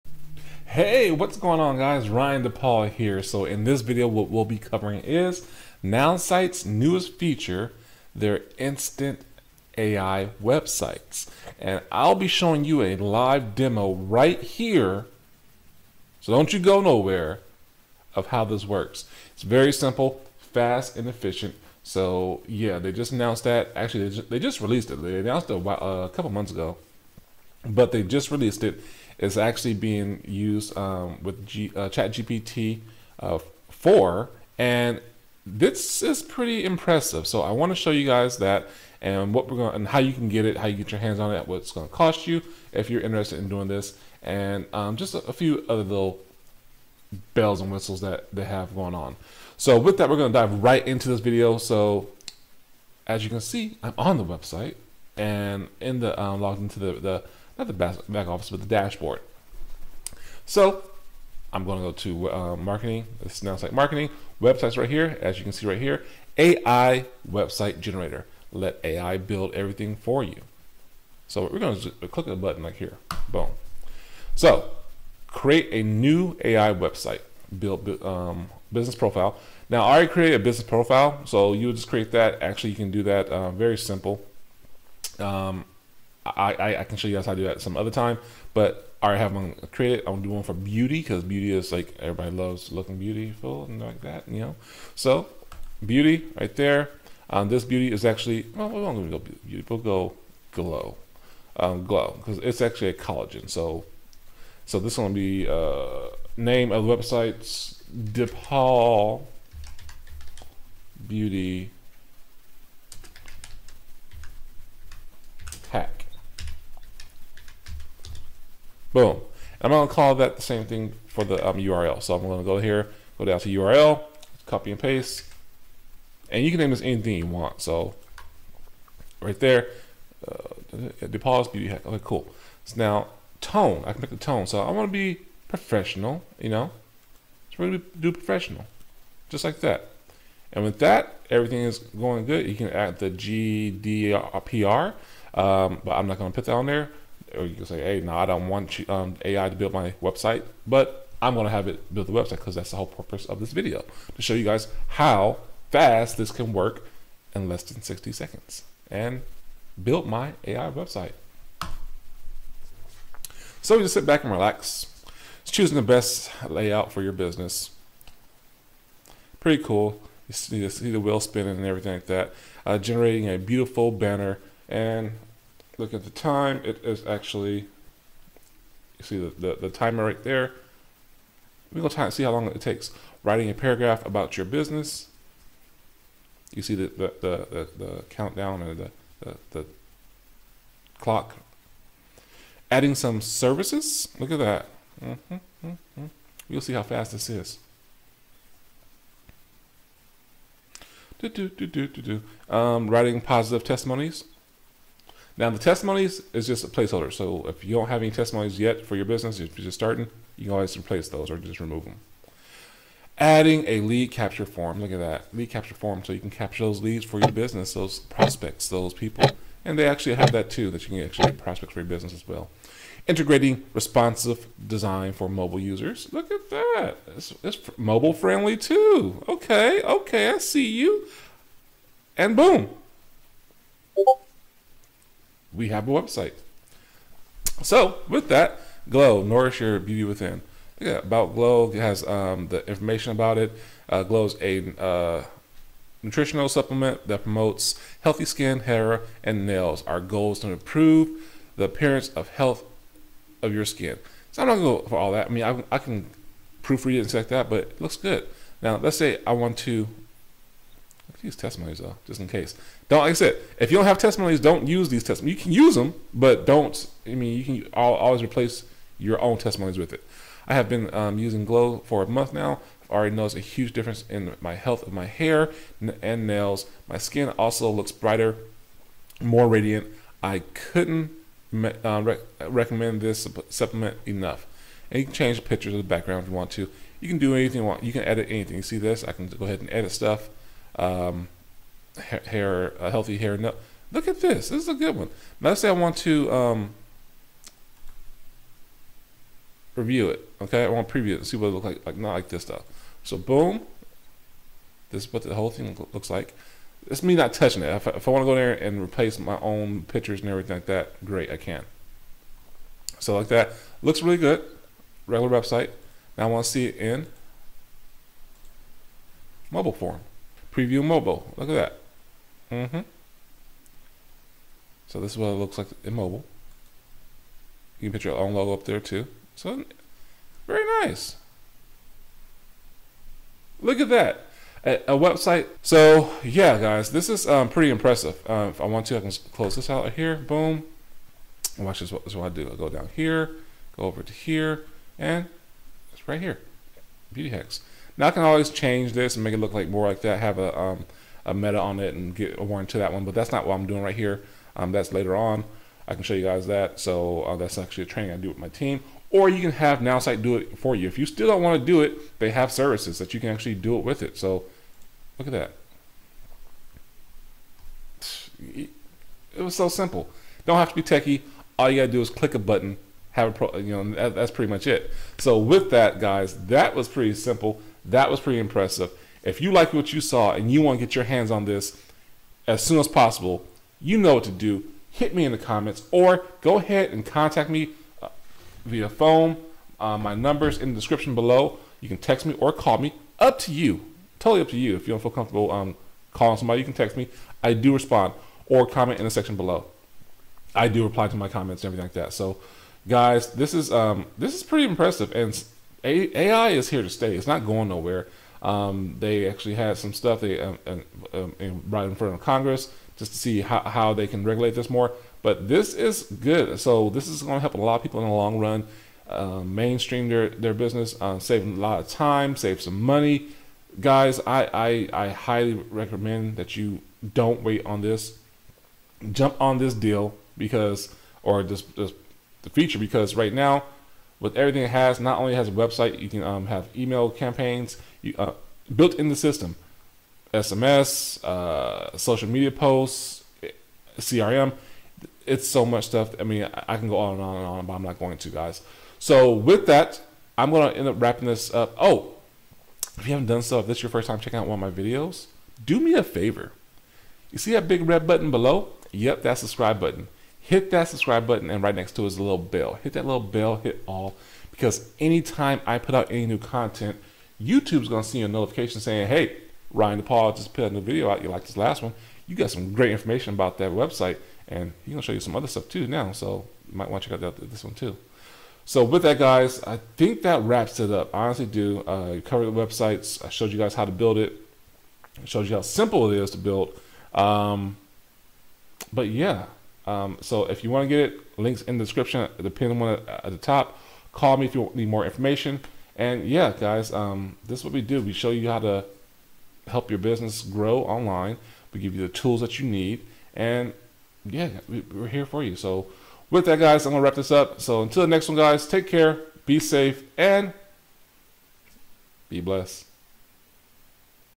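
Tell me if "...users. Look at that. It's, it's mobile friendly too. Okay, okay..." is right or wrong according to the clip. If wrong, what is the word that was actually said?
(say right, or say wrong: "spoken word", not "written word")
right.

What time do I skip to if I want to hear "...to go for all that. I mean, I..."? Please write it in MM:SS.
04:14.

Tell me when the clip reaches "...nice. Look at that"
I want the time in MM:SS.
05:30.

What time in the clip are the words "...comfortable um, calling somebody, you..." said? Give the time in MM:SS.
06:35.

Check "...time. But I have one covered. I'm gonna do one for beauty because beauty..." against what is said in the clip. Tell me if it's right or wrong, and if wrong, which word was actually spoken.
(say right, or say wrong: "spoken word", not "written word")
wrong: "created", not "covered".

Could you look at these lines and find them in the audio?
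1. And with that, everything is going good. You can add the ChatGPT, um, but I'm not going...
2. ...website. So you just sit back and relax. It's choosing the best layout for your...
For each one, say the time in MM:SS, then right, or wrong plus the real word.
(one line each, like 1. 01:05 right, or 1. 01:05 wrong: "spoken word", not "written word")
1. 02:20 wrong: "GDPR", not "ChatGPT"
2. 02:40 right.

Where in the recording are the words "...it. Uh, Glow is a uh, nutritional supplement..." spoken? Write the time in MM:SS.
04:03.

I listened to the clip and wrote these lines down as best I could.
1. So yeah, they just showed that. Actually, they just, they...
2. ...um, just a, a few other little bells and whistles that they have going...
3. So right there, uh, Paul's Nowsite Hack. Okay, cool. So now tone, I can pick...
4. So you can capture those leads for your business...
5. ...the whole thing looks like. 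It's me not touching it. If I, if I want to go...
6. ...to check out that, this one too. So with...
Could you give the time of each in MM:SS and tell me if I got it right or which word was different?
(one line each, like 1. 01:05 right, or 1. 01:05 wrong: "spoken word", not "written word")
1. 00:21 wrong: "announced", not "showed"
2. 00:44 right
3. 02:07 wrong: "Beauty", not "Nowsite"
4. 03:36 right
5. 05:05 right
6. 07:57 right.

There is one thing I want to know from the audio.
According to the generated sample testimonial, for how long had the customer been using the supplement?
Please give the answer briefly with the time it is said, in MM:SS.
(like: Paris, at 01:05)
a month, at 04:32.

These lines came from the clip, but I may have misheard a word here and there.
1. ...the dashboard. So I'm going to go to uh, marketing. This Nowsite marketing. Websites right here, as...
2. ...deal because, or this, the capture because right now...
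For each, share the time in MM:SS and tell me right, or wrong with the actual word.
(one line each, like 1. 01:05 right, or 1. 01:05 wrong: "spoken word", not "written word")
1. 00:58 right
2. 07:09 wrong: "feature", not "capture".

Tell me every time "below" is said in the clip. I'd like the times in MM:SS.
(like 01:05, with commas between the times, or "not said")
06:31, 06:39, 07:38.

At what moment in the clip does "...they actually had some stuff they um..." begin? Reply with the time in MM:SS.
06:48.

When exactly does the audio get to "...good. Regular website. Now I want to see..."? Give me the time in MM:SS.
05:14.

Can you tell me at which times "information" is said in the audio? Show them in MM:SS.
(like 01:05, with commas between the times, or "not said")
04:02, 07:52, 08:15.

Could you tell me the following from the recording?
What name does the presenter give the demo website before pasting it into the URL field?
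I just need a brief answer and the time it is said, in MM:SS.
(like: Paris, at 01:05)
DePaul Beauty, at 01:47.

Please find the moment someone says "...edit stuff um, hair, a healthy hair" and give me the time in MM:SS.
04:49.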